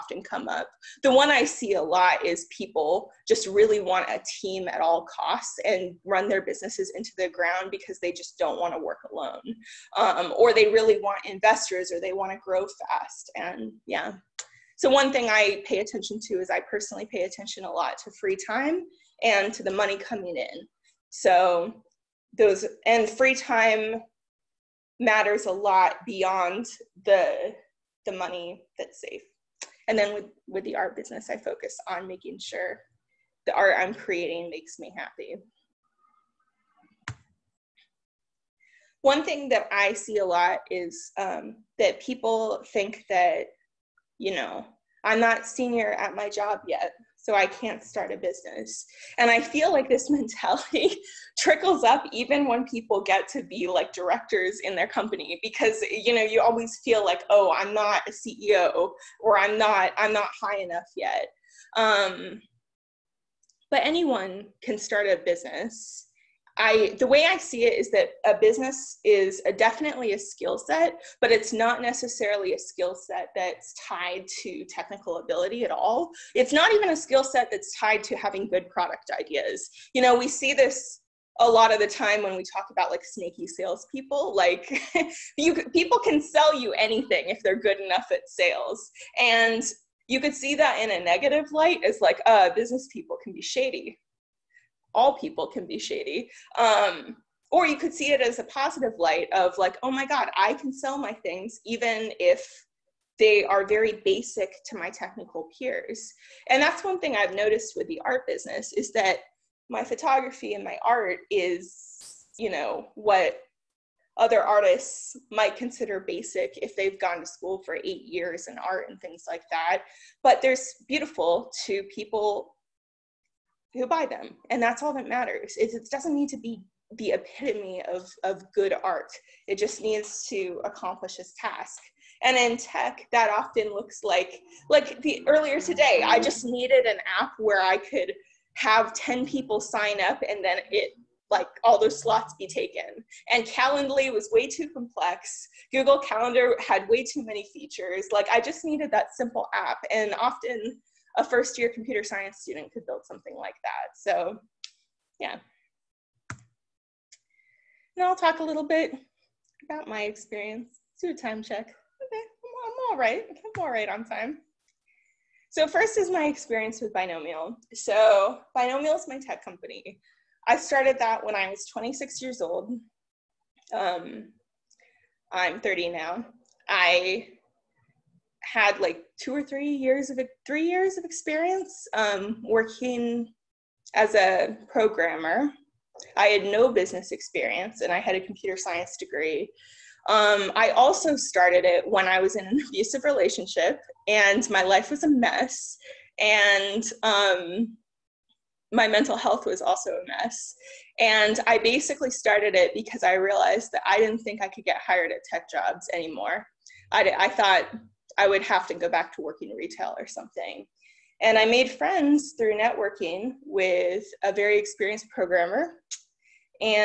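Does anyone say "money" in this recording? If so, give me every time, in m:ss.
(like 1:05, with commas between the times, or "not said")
0:19, 0:28.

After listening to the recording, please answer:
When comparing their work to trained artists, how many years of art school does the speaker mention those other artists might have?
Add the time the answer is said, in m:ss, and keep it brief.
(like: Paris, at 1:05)
8, at 1:57.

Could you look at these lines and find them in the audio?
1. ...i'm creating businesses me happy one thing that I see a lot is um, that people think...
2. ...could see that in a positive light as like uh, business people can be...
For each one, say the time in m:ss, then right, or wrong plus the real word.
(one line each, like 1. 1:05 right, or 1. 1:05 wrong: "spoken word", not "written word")
1. 0:33 wrong: "makes", not "businesses"
2. 1:30 wrong: "negative", not "positive".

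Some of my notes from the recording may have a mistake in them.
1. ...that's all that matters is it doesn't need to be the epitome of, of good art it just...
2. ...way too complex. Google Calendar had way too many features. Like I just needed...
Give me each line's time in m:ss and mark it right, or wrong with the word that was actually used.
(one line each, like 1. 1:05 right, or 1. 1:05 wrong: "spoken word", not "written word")
1. 2:04 right
2. 2:24 right.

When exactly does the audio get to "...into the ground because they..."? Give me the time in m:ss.
0:06.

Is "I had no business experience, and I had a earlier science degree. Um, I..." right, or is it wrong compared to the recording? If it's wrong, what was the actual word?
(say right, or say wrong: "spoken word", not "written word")
wrong: "computer", not "earlier".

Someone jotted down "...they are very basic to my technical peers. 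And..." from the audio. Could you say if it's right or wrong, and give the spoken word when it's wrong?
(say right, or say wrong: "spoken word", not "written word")
right.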